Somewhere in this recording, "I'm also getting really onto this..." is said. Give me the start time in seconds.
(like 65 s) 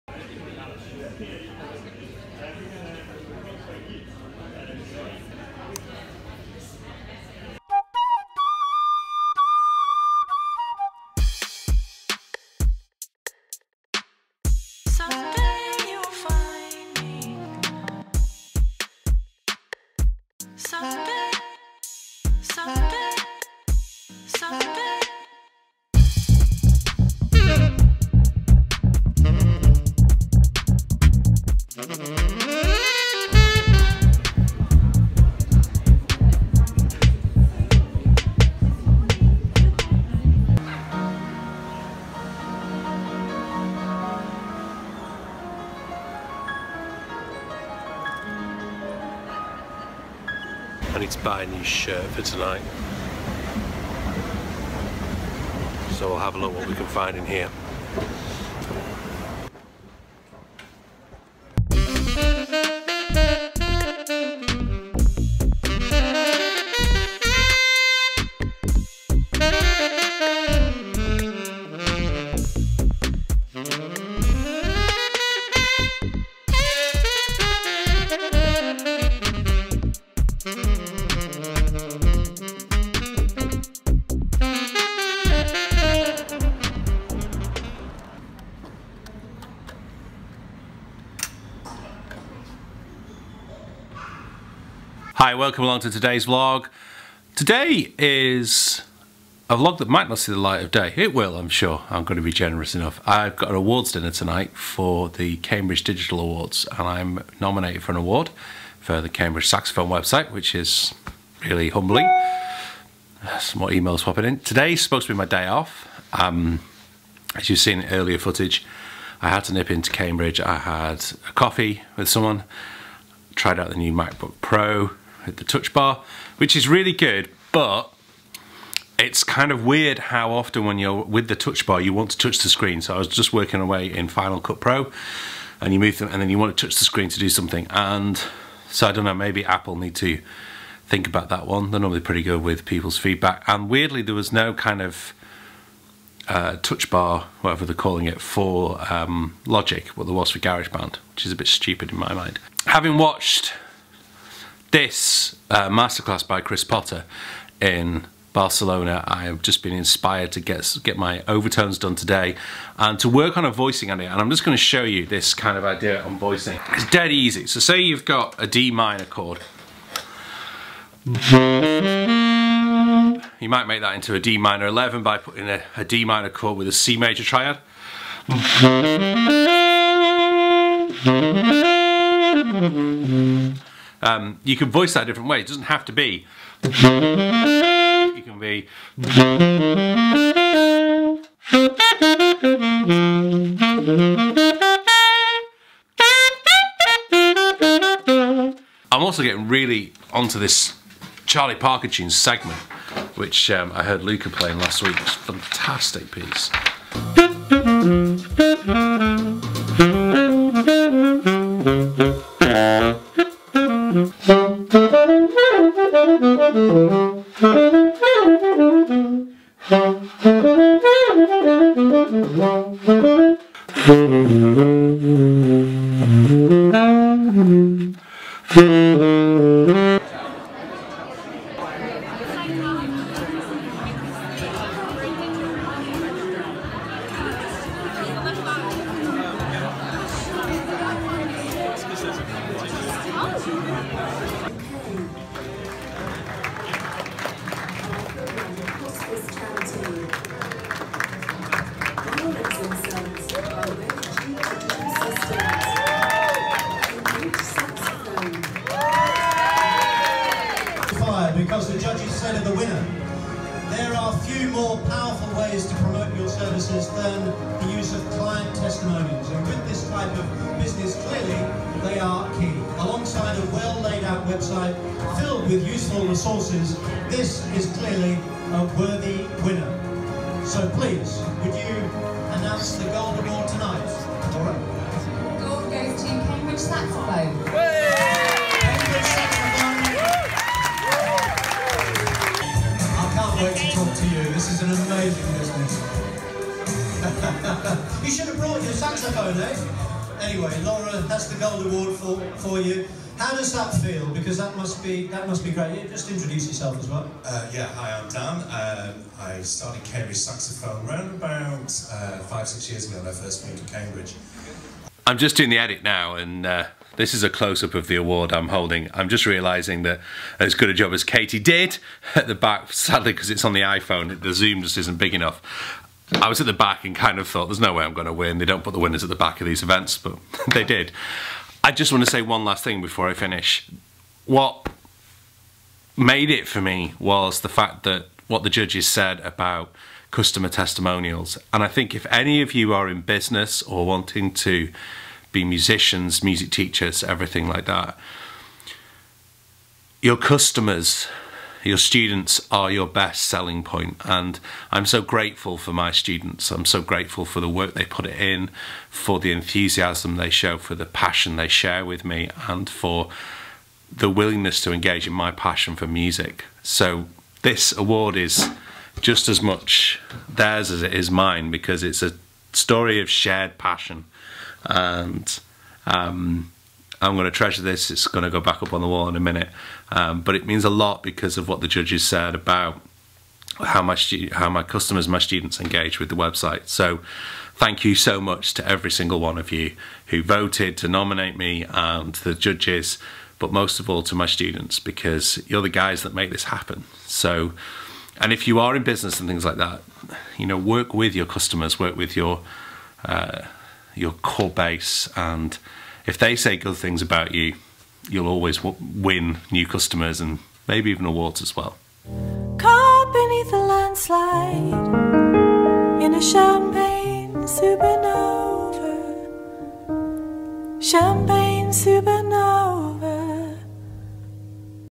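198 s.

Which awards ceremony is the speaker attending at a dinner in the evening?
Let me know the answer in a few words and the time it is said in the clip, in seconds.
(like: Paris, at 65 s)
Cambridge Digital Awards, at 105 s.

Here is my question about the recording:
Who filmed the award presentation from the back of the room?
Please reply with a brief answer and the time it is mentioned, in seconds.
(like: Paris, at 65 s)
Katie, at 321 s.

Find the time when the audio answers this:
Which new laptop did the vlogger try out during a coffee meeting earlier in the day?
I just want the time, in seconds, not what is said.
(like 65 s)
123 s.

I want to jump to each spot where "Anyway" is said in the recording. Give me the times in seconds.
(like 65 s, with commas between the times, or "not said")
300 s.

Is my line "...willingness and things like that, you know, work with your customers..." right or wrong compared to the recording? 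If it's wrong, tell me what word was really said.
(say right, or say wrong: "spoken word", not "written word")
wrong: "business", not "willingness".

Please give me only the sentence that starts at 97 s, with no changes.
Today is a vlog that might not see the light of day.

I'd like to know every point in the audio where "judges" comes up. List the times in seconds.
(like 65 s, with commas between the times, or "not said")
338 s, 381 s, 392 s.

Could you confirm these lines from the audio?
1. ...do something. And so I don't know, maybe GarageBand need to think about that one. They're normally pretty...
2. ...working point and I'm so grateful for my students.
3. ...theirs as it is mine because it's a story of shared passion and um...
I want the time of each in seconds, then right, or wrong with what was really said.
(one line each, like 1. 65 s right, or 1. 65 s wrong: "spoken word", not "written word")
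1. 137 s wrong: "Apple", not "GarageBand"
2. 353 s wrong: "selling", not "working"
3. 370 s right.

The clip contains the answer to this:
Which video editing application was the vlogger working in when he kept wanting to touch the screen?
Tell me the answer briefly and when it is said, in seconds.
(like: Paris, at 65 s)
Final Cut Pro, at 134 s.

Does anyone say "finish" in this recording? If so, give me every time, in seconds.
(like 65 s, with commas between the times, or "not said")
333 s.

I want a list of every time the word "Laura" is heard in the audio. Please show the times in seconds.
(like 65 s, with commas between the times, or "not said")
300 s.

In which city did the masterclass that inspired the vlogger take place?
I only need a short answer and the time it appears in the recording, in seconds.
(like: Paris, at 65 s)
Barcelona, at 158 s.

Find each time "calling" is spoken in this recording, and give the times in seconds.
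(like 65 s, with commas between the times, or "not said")
147 s.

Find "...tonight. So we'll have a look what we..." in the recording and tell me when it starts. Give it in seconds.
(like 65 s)
52 s.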